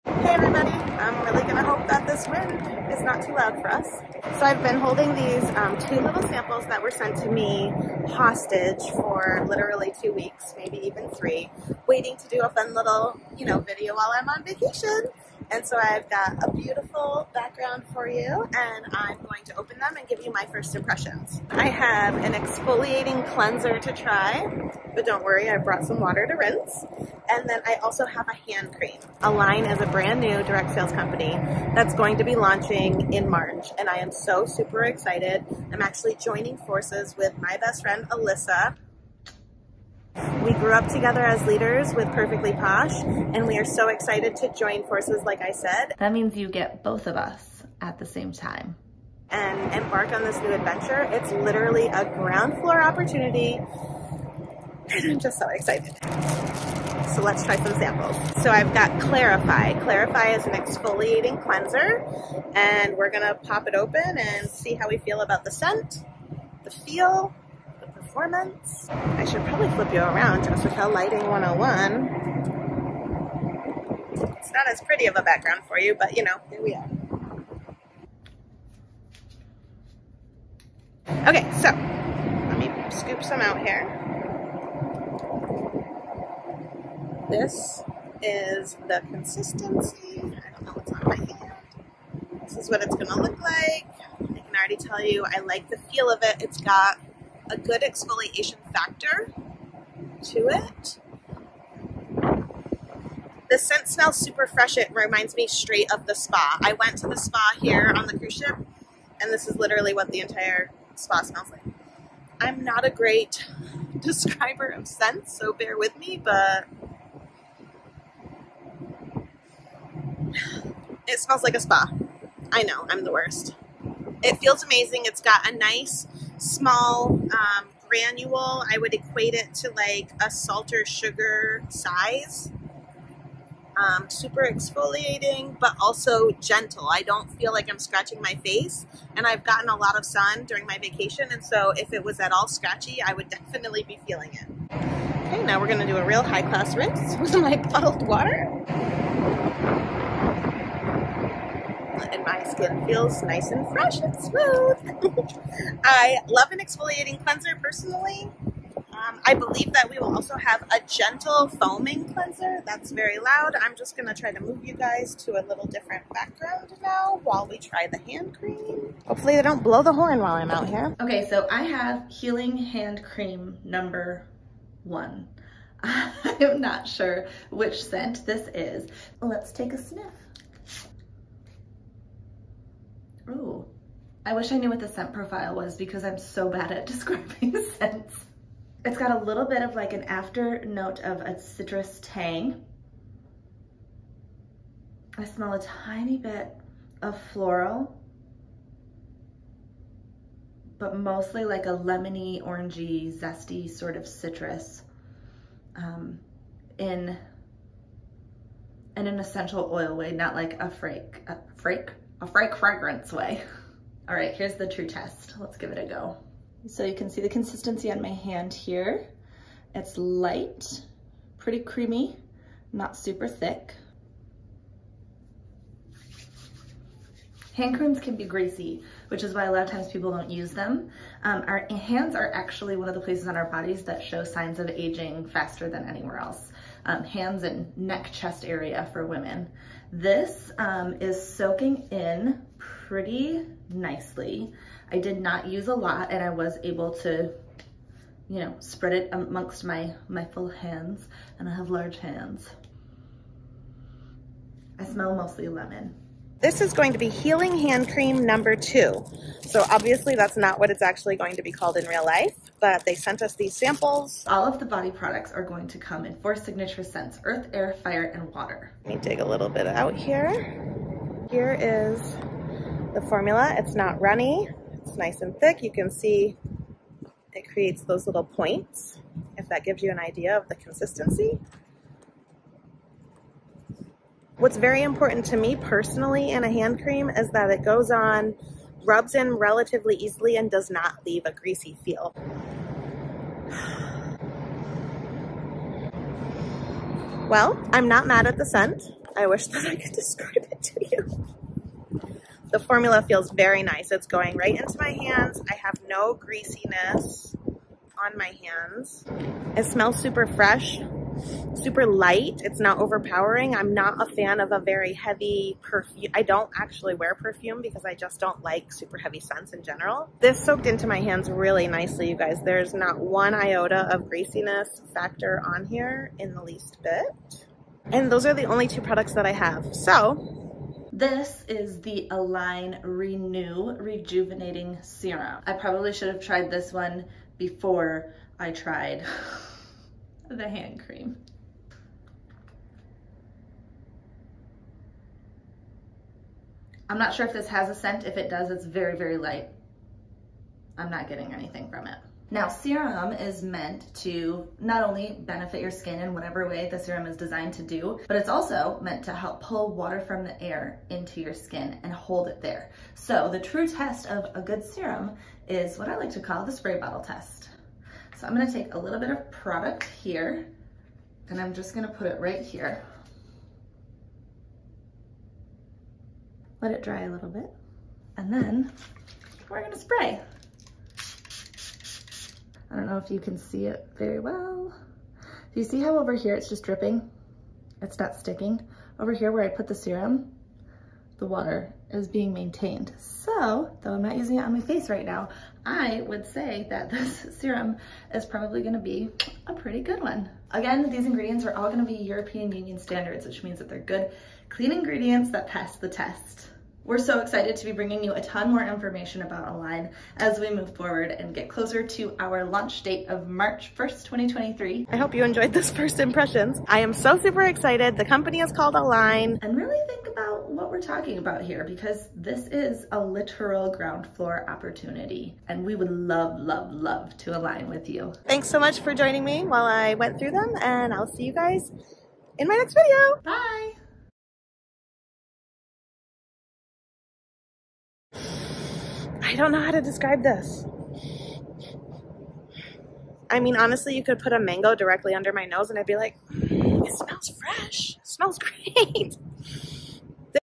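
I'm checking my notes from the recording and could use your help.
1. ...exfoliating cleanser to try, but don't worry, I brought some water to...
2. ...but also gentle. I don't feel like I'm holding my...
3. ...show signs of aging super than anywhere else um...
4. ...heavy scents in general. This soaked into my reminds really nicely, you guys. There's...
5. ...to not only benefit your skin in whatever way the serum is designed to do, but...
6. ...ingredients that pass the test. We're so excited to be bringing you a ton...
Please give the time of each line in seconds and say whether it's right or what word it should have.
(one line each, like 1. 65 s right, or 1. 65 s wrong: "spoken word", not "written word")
1. 22 s right
2. 135 s wrong: "scratching", not "holding"
3. 234 s wrong: "faster", not "super"
4. 318 s wrong: "hands", not "reminds"
5. 353 s right
6. 404 s right.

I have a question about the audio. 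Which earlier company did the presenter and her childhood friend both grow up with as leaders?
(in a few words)
Perfectly Posh.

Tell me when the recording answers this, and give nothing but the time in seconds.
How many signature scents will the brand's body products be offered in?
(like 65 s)
266 s.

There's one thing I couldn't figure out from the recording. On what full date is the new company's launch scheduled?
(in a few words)
March 1st, 2023.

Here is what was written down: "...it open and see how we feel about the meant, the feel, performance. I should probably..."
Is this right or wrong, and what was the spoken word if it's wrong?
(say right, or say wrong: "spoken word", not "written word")
wrong: "scent", not "meant".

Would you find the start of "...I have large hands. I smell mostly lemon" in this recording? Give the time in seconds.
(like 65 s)
251 s.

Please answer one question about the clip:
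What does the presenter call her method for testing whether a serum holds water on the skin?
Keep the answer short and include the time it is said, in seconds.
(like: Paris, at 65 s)
spray bottle test, at 366 s.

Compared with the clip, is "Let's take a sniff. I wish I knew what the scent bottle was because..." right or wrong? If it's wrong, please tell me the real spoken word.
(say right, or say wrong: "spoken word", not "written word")
wrong: "profile", not "bottle".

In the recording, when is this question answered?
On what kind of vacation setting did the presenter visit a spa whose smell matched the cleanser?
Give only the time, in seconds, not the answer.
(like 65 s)
108 s.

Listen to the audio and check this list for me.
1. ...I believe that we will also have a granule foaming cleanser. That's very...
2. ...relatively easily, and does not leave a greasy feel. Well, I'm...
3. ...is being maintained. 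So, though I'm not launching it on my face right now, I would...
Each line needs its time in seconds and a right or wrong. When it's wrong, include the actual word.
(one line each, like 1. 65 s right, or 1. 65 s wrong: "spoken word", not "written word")
1. 159 s wrong: "gentle", not "granule"
2. 289 s right
3. 391 s wrong: "using", not "launching".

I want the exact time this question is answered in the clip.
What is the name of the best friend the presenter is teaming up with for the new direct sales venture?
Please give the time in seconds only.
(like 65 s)
38 s.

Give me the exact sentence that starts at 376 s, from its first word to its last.
Let it dry a little bit and then we're gonna spray.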